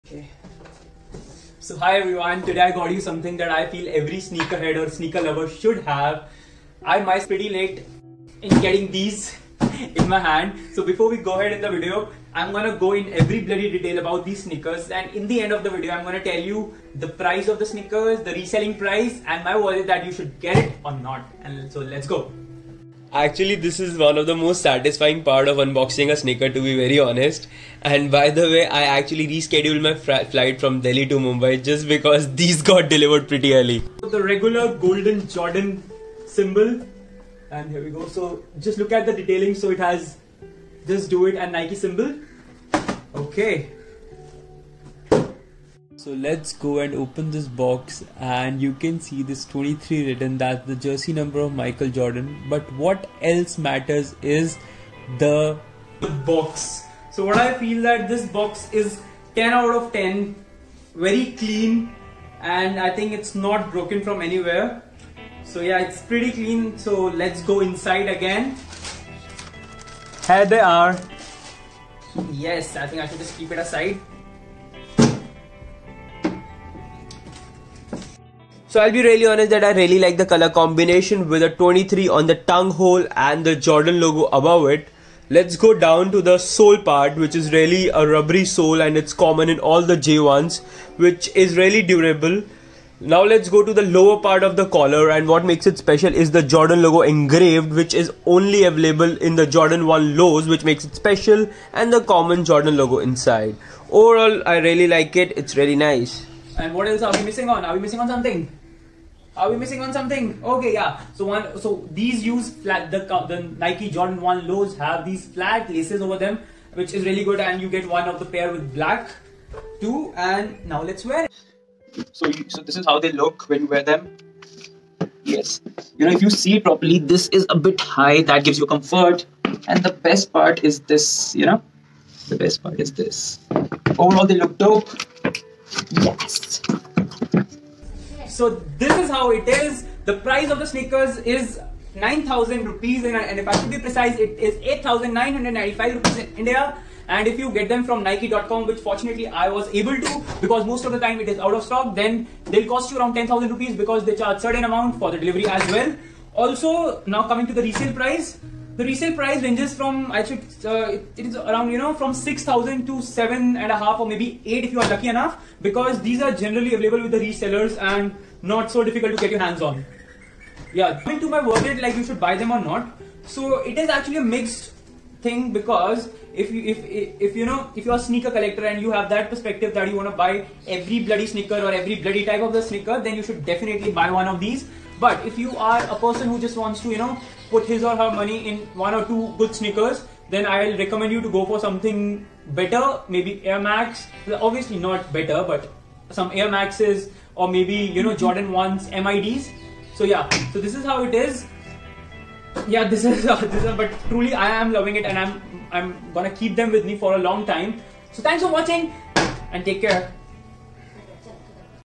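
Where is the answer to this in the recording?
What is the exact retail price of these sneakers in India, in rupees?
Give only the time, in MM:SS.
02:24.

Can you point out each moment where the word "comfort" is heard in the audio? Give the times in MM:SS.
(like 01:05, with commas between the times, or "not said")
02:08.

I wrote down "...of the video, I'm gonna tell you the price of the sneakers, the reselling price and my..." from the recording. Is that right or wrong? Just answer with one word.
right.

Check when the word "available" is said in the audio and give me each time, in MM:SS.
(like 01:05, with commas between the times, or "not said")
01:38, 02:46.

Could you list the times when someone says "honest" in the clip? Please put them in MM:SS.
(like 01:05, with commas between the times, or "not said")
00:26, 01:19.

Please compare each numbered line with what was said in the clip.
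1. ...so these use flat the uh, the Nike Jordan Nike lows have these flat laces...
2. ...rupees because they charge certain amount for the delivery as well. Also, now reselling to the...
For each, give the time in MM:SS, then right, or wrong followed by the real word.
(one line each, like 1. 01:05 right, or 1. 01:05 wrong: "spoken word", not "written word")
1. 01:51 wrong: "One", not "Nike"
2. 02:33 wrong: "coming", not "reselling".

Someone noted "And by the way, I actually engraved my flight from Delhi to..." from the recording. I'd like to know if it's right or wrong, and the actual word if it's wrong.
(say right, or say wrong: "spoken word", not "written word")
wrong: "rescheduled", not "engraved".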